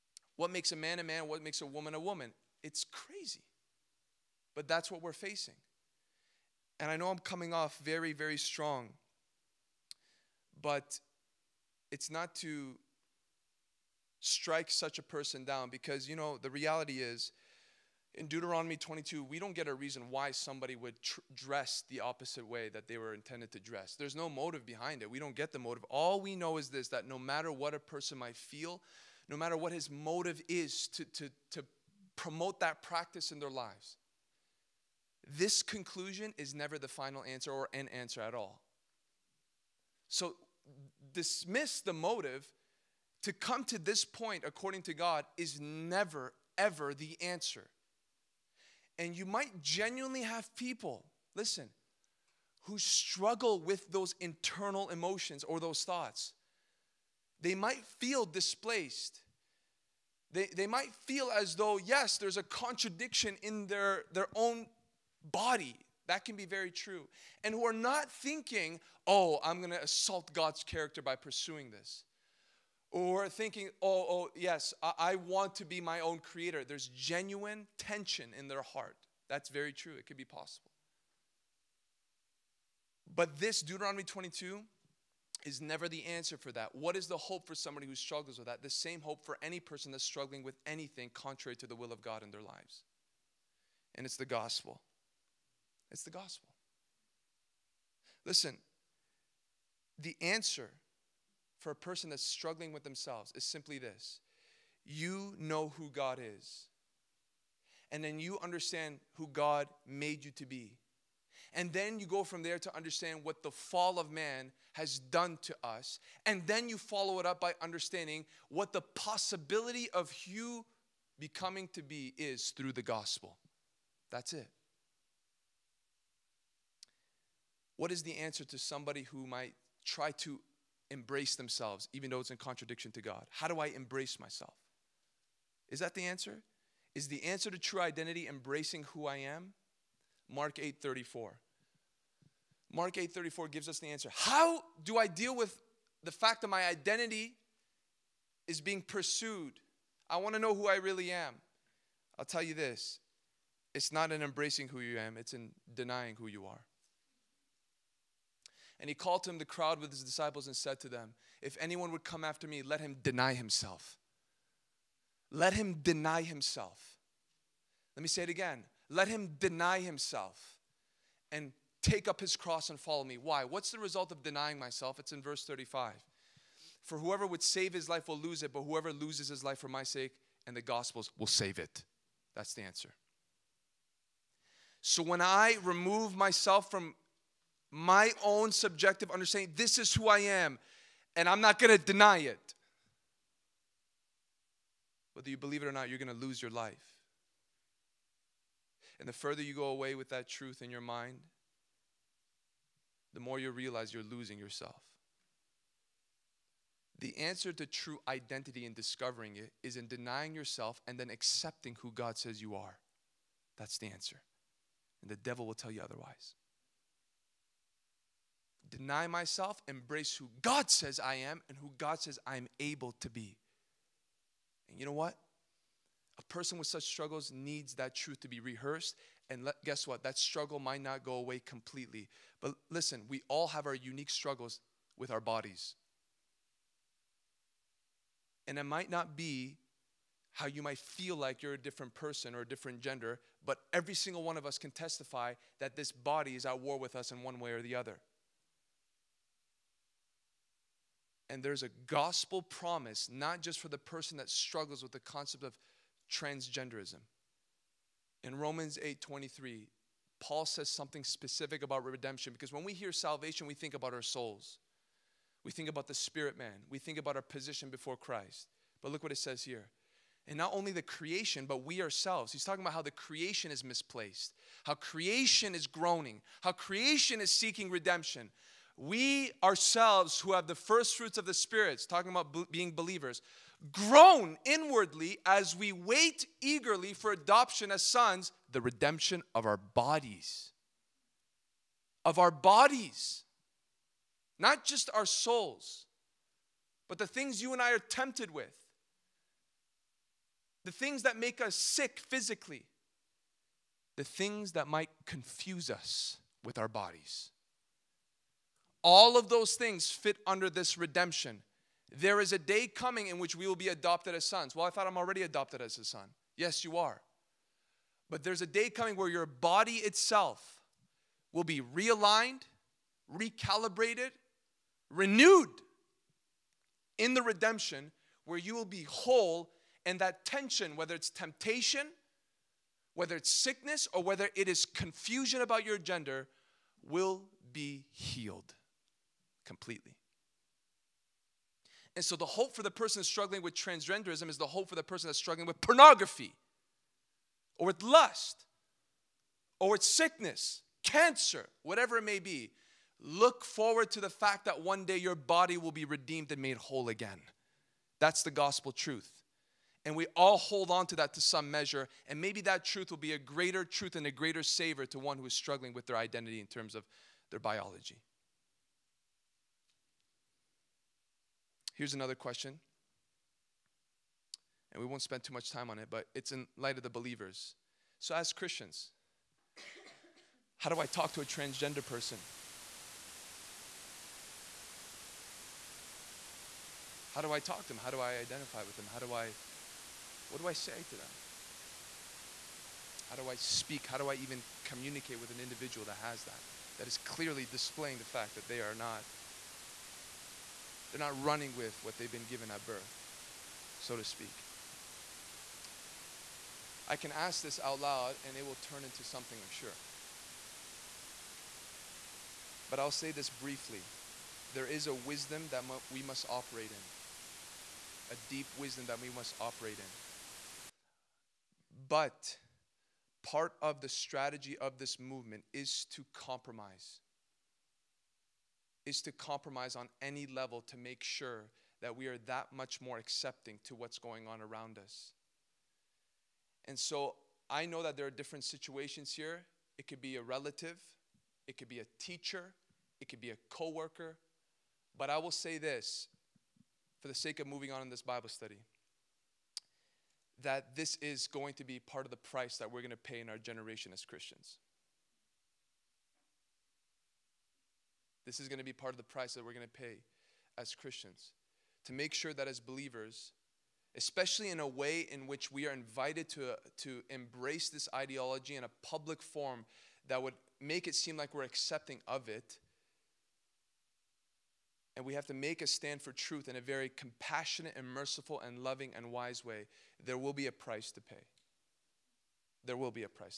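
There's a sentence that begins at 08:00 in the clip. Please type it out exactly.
There will be a price to pay.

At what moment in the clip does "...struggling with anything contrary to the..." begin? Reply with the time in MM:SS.
01:30.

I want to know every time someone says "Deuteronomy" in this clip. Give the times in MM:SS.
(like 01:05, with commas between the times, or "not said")
00:18, 01:23.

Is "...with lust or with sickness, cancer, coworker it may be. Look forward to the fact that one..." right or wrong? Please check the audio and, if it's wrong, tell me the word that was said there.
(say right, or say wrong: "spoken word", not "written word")
wrong: "whatever", not "coworker".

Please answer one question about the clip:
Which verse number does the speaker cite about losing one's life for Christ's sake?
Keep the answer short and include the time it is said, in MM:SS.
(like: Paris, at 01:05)
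35, at 02:55.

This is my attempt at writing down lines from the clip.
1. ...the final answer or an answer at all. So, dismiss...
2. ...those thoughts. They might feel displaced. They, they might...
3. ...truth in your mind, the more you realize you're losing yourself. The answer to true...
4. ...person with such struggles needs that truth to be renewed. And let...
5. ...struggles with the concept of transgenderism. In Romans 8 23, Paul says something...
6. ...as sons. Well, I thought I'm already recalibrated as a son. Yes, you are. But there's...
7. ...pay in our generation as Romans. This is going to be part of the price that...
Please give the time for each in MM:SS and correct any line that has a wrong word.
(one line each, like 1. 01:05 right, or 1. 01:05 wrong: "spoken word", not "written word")
1. 00:36 right
2. 00:55 right
3. 03:20 right
4. 03:46 wrong: "rehearsed", not "renewed"
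5. 04:14 right
6. 05:14 wrong: "adopted", not "recalibrated"
7. 07:32 wrong: "Christians", not "Romans".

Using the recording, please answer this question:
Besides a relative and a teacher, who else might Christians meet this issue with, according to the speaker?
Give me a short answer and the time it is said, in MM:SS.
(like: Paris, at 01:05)
coworker, at 07:23.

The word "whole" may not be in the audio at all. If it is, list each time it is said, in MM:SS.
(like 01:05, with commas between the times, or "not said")
05:28, 05:56.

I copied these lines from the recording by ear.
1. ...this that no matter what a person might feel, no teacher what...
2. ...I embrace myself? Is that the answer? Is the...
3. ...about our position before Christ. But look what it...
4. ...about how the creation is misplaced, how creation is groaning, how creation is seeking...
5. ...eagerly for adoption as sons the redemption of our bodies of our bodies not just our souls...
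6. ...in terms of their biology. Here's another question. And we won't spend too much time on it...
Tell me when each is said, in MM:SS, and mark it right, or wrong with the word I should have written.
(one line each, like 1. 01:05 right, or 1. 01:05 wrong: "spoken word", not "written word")
1. 00:26 wrong: "matter", not "teacher"
2. 02:13 right
3. 04:26 right
4. 04:32 right
5. 04:46 right
6. 06:06 right.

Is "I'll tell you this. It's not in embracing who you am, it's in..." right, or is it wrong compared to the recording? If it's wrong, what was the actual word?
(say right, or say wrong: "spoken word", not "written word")
right.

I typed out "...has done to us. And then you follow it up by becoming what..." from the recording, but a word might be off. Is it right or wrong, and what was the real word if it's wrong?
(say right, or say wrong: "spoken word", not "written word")
wrong: "understanding", not "becoming".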